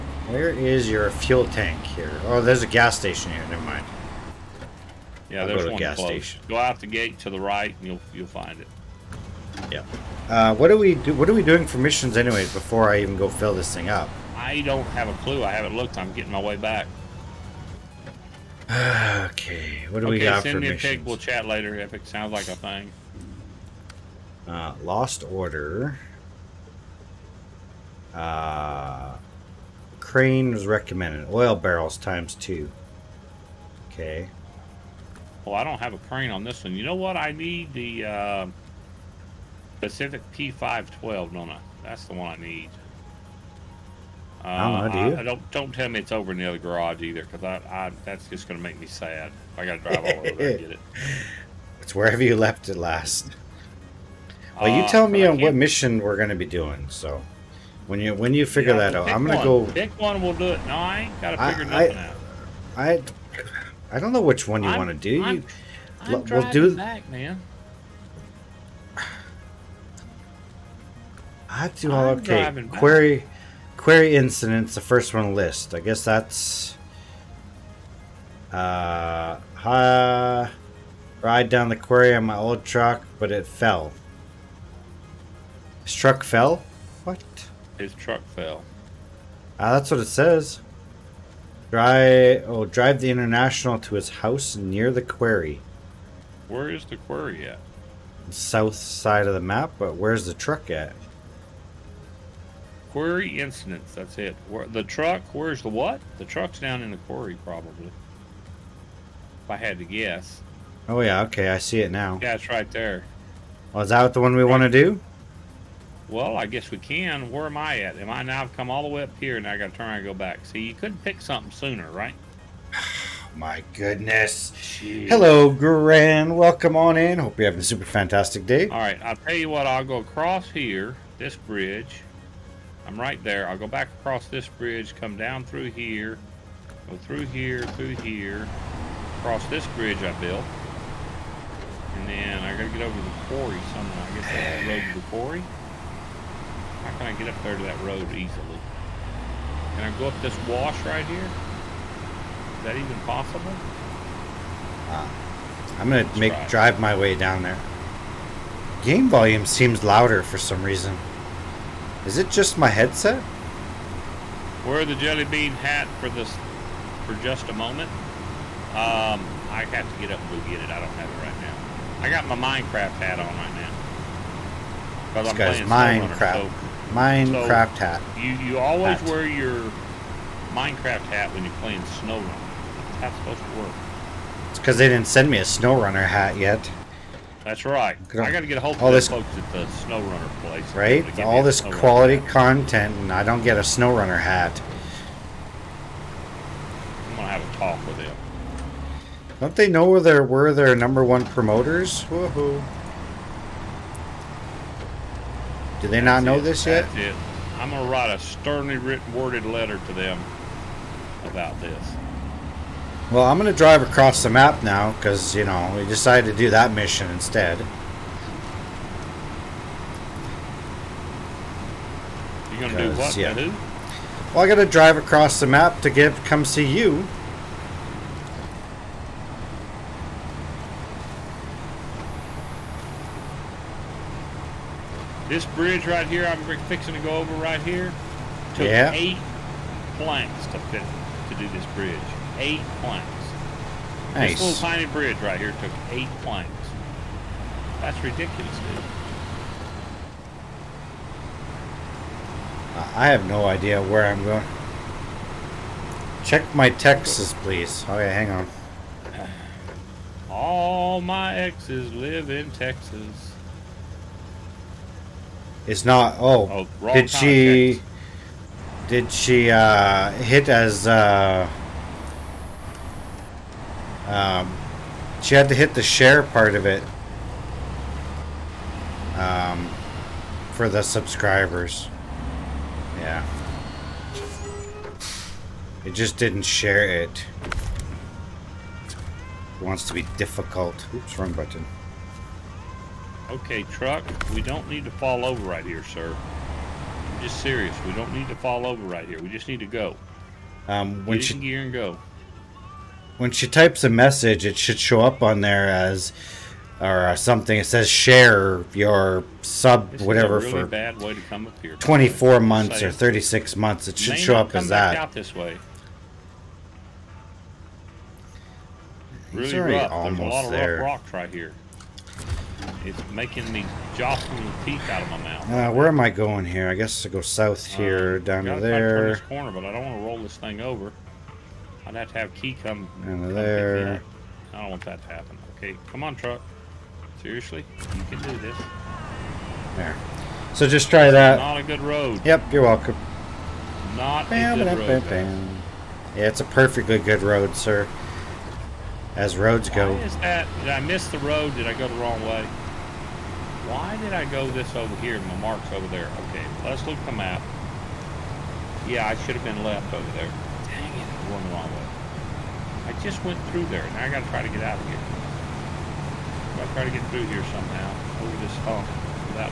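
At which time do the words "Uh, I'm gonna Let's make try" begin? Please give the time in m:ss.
2:34.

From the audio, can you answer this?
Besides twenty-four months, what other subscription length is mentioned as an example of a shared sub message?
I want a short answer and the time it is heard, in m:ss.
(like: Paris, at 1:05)
36 months, at 5:12.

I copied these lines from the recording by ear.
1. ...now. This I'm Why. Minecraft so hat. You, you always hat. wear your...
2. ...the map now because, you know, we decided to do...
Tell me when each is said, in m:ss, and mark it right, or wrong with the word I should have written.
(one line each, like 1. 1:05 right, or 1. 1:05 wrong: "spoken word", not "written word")
1. 2:55 wrong: "Minecraft", not "Why"
2. 3:34 right.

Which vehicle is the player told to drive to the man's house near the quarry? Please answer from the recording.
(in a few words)
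The International.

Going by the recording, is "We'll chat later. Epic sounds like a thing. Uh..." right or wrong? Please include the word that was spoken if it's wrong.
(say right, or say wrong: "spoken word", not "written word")
right.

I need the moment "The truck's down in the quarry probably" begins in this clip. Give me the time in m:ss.
1:46.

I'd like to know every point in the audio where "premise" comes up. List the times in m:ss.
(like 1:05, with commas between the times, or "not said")
not said.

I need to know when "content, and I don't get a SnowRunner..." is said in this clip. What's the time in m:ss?
3:12.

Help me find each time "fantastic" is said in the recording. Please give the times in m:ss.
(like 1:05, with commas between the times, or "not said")
2:07.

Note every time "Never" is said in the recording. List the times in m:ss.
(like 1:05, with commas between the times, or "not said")
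0:03.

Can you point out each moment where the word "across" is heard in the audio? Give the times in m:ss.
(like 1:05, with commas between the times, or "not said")
2:09, 2:13, 2:19, 3:33, 3:44.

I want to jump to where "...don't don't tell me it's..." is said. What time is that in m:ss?
0:45.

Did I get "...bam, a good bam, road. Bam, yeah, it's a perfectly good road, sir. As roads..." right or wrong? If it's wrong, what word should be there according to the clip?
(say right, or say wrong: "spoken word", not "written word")
right.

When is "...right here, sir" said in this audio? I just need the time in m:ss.
4:55.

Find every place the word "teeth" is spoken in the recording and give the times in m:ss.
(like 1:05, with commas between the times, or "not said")
5:24.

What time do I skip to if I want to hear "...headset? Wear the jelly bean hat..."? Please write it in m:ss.
2:42.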